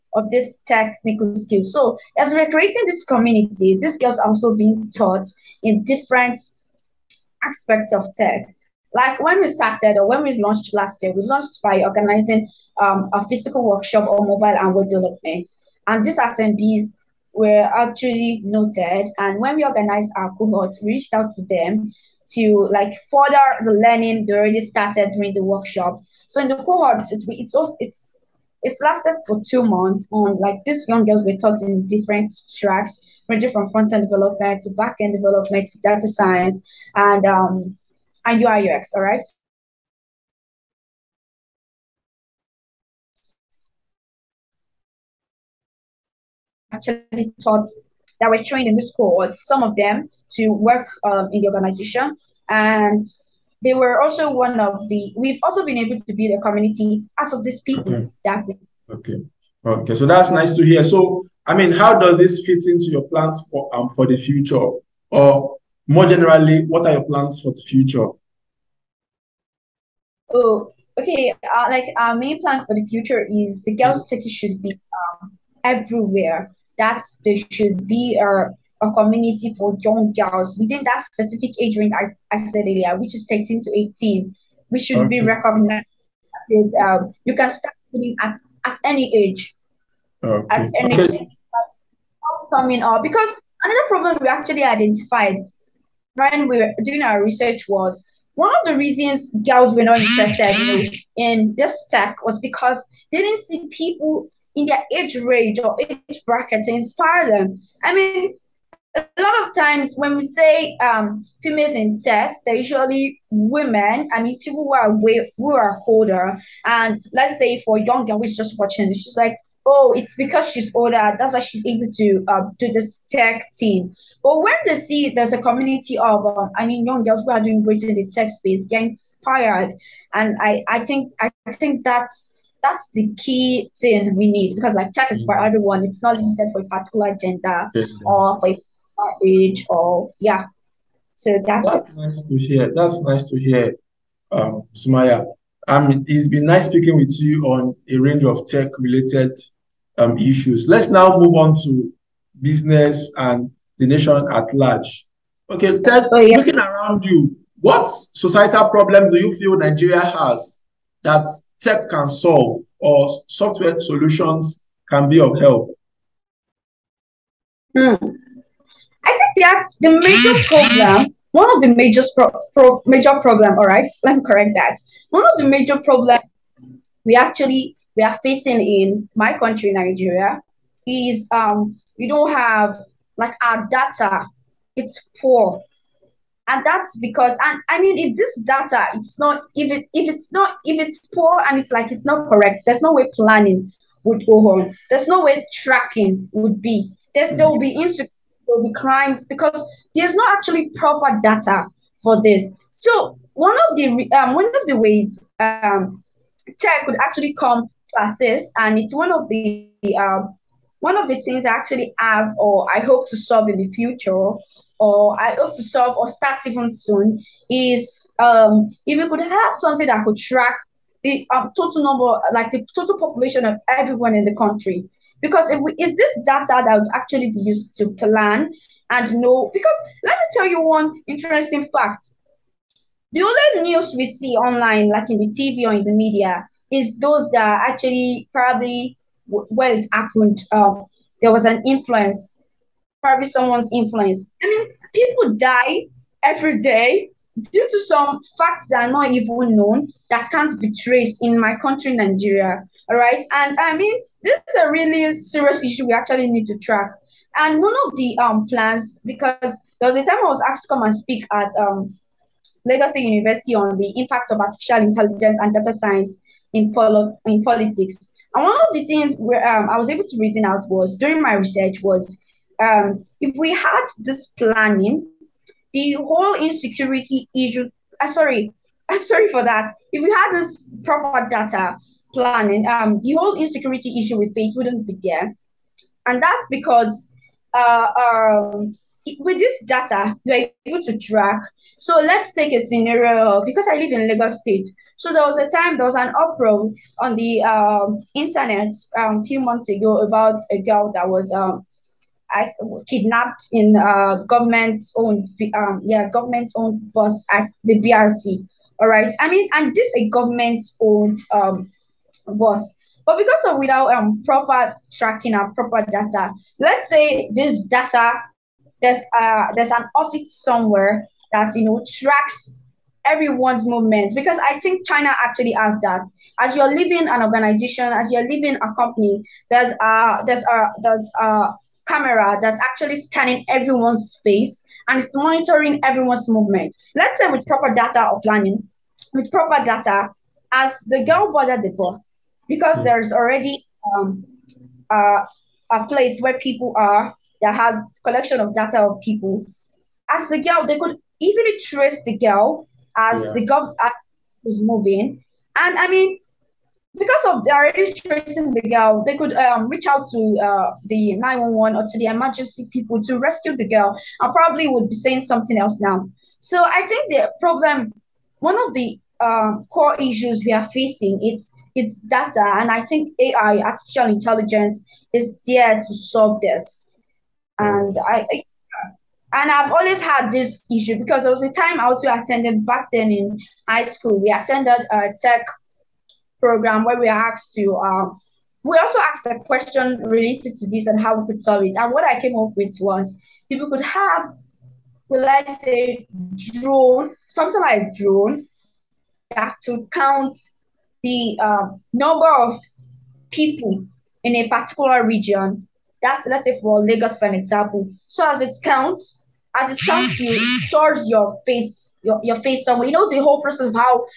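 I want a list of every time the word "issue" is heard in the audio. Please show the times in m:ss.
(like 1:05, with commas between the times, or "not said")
2:30, 4:15, 4:37, 4:43, 6:10, 6:20.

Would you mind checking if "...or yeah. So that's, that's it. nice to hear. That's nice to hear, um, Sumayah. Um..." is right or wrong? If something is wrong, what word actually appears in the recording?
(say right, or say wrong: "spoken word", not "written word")
right.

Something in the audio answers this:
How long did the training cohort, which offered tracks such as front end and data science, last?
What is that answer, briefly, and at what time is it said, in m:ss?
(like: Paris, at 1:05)
2 months, at 0:29.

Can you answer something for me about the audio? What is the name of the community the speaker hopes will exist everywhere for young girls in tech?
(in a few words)
Girls Techie.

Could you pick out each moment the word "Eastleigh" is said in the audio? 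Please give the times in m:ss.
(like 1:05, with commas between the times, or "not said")
not said.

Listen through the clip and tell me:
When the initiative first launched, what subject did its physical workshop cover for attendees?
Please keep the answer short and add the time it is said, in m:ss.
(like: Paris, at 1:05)
mobile and web development, at 0:14.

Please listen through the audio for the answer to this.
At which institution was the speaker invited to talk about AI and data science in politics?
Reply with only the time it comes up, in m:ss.
4:22.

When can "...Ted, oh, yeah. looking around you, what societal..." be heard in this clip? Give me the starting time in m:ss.
2:35.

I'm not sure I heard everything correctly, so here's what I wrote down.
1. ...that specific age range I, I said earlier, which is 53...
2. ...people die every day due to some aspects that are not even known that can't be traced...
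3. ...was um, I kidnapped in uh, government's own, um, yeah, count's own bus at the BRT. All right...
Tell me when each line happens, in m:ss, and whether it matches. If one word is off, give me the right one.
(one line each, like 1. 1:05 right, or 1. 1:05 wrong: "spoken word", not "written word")
1. 1:20 wrong: "13", not "53"
2. 4:04 wrong: "facts", not "aspects"
3. 5:01 wrong: "government", not "count".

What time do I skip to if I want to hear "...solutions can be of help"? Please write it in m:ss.
2:43.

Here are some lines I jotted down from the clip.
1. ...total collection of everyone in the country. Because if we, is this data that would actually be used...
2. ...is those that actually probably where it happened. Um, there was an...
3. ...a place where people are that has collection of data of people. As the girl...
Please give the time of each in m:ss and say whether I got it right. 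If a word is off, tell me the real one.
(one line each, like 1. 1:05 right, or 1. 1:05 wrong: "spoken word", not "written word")
1. 3:42 wrong: "population", not "collection"
2. 3:56 right
3. 5:45 right.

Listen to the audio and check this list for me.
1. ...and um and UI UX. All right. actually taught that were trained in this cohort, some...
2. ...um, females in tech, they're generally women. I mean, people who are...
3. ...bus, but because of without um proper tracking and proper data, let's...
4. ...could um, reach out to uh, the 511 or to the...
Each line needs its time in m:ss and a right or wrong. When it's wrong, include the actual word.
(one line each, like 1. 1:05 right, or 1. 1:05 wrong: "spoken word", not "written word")
1. 0:36 right
2. 1:50 wrong: "usually", not "generally"
3. 5:12 right
4. 5:59 wrong: "911", not "511".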